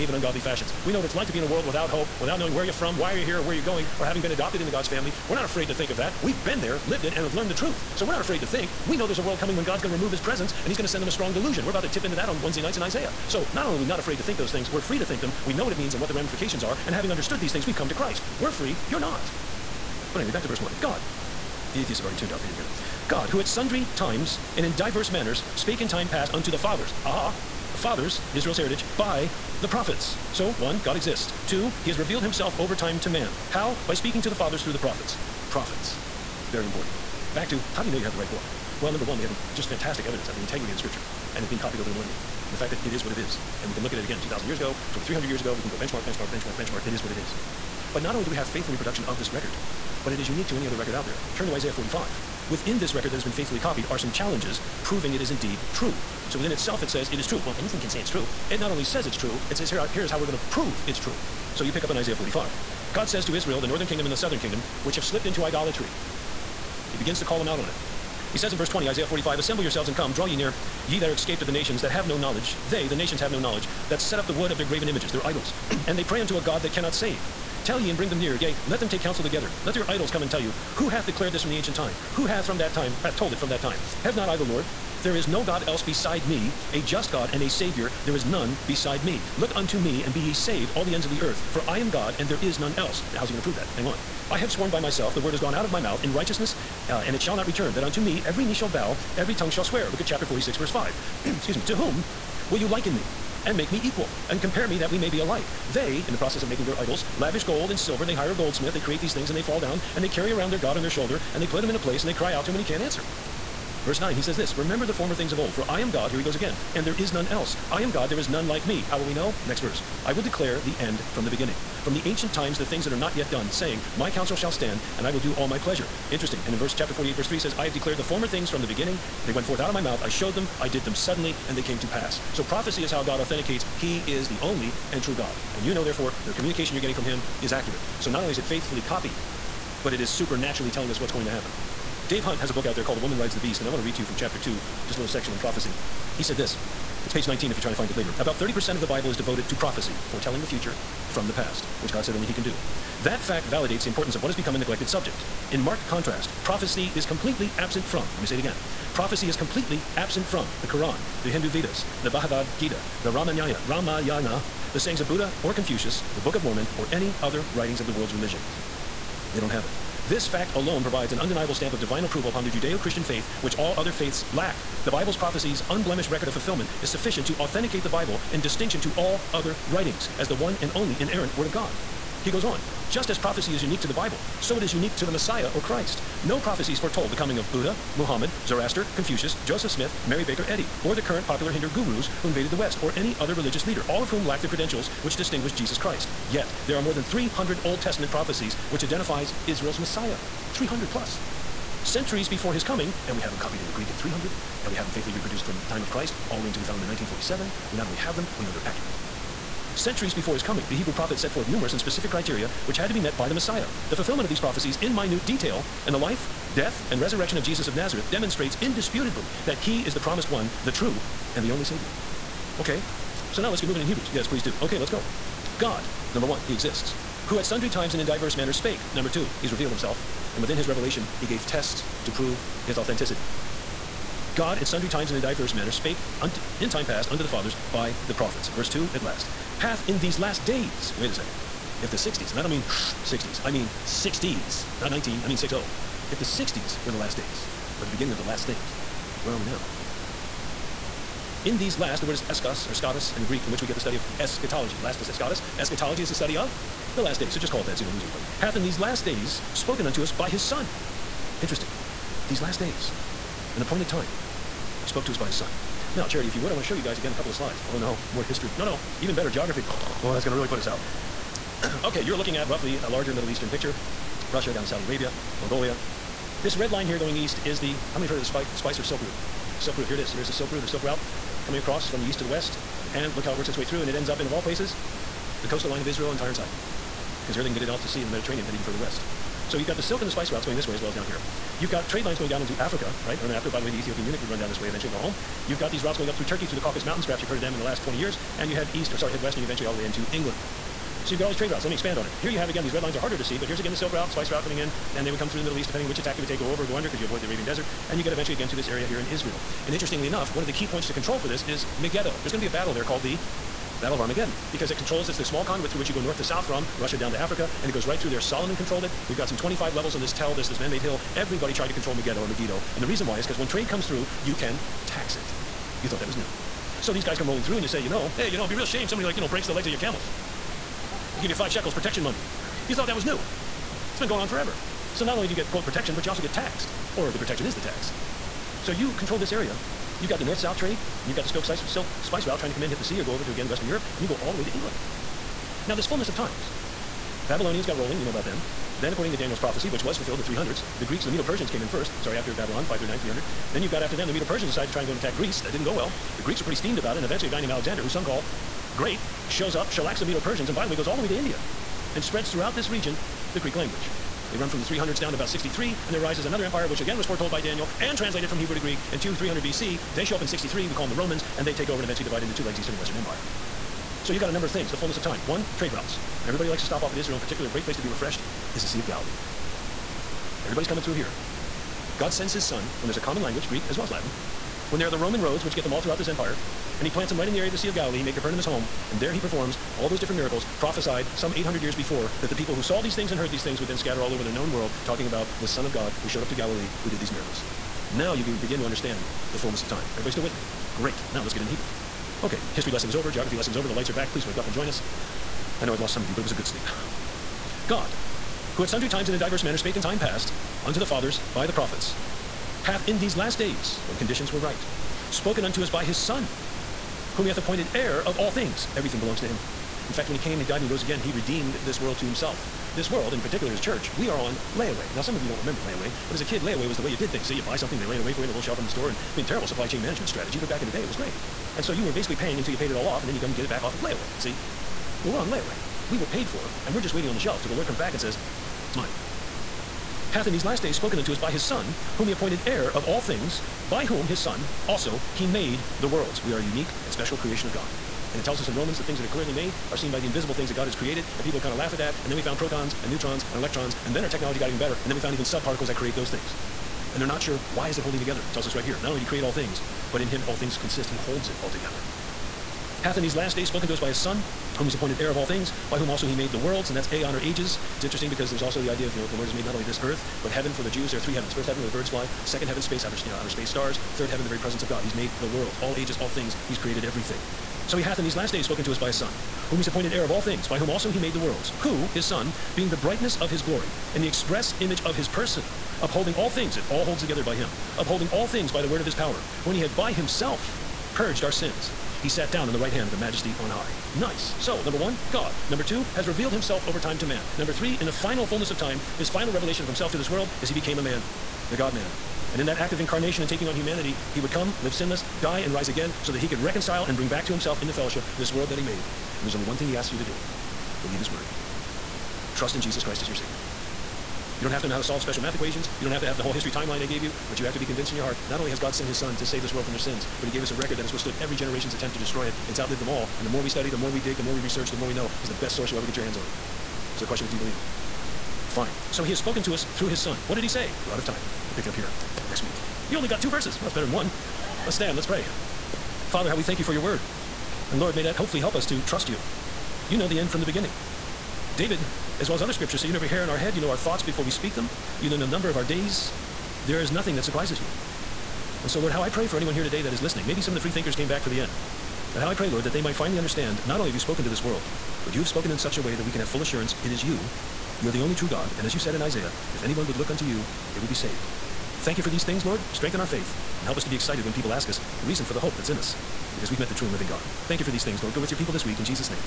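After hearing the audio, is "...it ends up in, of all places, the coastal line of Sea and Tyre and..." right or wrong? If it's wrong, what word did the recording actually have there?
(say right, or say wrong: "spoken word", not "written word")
wrong: "Israel", not "Sea".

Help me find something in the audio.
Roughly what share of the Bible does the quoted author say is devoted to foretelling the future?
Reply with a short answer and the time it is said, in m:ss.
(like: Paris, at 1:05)
30%, at 2:28.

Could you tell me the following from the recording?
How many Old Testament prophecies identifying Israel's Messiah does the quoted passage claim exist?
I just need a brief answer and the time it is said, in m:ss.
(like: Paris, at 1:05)
more than 300, at 3:16.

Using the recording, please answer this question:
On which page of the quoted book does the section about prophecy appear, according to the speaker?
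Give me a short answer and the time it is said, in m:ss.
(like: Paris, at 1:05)
19, at 2:27.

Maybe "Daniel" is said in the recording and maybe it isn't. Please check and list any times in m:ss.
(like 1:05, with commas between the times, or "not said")
5:49, 6:07.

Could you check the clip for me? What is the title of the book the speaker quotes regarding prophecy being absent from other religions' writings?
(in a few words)
A Woman Rides the Beast.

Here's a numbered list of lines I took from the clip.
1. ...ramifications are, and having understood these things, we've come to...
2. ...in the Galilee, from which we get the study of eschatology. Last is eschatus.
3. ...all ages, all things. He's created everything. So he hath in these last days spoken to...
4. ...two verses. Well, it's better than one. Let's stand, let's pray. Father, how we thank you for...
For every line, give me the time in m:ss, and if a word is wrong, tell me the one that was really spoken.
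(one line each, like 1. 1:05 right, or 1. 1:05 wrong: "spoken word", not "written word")
1. 0:16 right
2. 4:13 wrong: "Greek", not "Galilee"
3. 7:55 right
4. 8:53 right.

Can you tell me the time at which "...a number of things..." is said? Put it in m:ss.
6:14.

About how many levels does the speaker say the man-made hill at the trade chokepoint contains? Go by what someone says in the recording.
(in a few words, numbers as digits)
25.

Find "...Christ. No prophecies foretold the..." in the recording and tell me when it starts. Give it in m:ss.
3:05.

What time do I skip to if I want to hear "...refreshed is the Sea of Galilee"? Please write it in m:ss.
6:17.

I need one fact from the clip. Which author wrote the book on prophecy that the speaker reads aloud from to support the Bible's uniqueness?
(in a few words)
Dave Hunt.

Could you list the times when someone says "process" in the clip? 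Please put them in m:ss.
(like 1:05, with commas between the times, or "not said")
1:46.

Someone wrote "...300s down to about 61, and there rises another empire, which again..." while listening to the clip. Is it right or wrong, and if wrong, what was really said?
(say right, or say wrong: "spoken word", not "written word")
wrong: "63", not "61".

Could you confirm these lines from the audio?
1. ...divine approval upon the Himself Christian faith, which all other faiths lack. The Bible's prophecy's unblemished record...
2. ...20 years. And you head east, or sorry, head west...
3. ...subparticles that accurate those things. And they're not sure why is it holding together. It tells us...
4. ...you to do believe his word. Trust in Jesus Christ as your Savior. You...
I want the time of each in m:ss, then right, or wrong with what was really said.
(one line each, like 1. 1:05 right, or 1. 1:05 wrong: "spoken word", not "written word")
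1. 2:51 wrong: "Judeo", not "Himself"
2. 4:57 right
3. 7:35 wrong: "create", not "accurate"
4. 8:29 right.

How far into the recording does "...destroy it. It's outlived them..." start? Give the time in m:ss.
8:41.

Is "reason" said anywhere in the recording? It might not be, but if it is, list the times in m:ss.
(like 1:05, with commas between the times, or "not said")
5:22, 9:25.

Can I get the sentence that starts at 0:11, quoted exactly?
We're about to tip into that on Wednesday nights in Isaiah.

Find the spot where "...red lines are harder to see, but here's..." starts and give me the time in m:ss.
5:02.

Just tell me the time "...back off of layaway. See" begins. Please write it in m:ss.
7:13.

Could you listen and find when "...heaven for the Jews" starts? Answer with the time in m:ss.
7:50.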